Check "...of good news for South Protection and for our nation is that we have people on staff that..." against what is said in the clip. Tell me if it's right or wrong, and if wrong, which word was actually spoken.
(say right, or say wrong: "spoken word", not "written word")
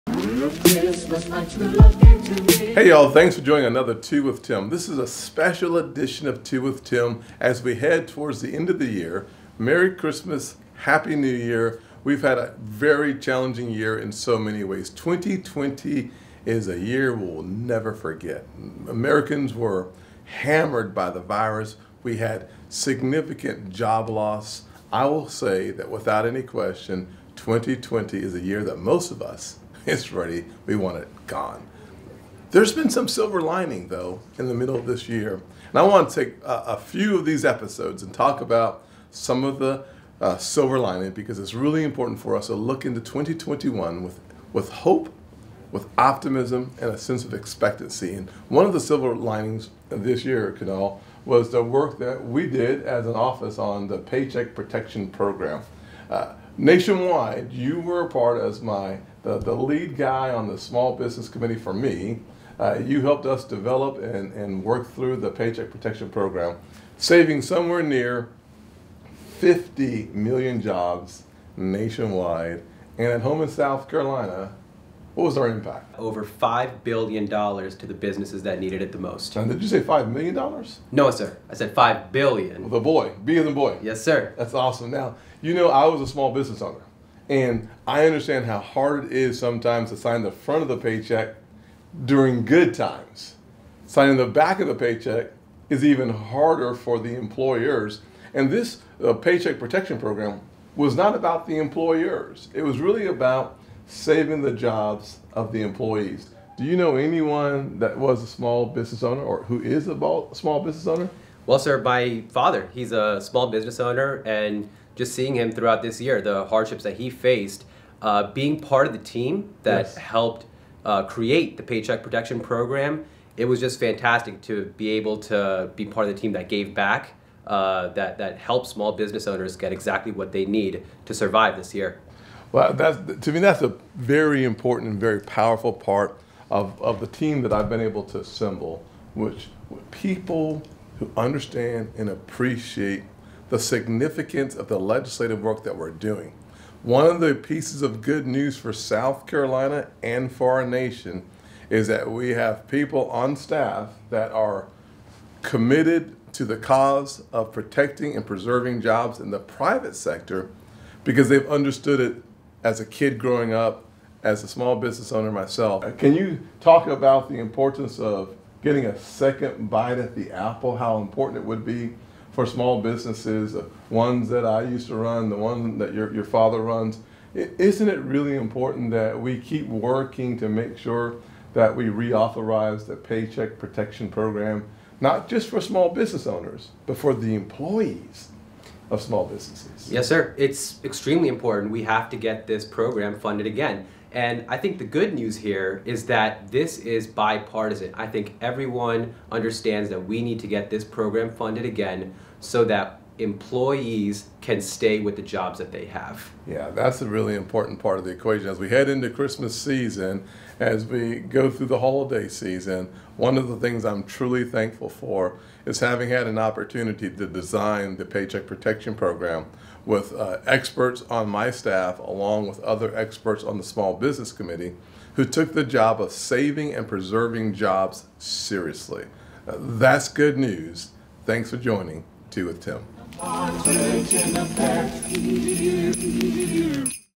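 wrong: "Carolina", not "Protection".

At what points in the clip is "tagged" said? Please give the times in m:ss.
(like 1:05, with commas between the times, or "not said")
not said.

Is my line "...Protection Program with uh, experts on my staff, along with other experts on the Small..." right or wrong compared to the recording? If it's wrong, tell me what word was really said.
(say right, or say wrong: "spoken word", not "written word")
right.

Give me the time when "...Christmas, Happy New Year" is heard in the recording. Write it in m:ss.
0:09.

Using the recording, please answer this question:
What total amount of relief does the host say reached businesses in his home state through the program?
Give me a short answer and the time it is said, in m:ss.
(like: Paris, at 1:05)
$5 billion, at 1:15.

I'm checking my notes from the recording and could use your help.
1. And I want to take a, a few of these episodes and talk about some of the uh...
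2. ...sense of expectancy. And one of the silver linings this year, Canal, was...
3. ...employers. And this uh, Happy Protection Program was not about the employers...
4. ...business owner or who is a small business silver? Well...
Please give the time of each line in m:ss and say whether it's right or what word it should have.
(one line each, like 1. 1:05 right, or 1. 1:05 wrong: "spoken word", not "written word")
1. 0:35 right
2. 0:46 right
3. 1:37 wrong: "Paycheck", not "Happy"
4. 1:48 wrong: "owner", not "silver".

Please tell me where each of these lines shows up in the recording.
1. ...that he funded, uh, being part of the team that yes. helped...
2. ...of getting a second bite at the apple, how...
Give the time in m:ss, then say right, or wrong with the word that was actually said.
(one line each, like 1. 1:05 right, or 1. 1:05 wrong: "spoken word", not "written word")
1. 1:56 wrong: "faced", not "funded"
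2. 2:47 right.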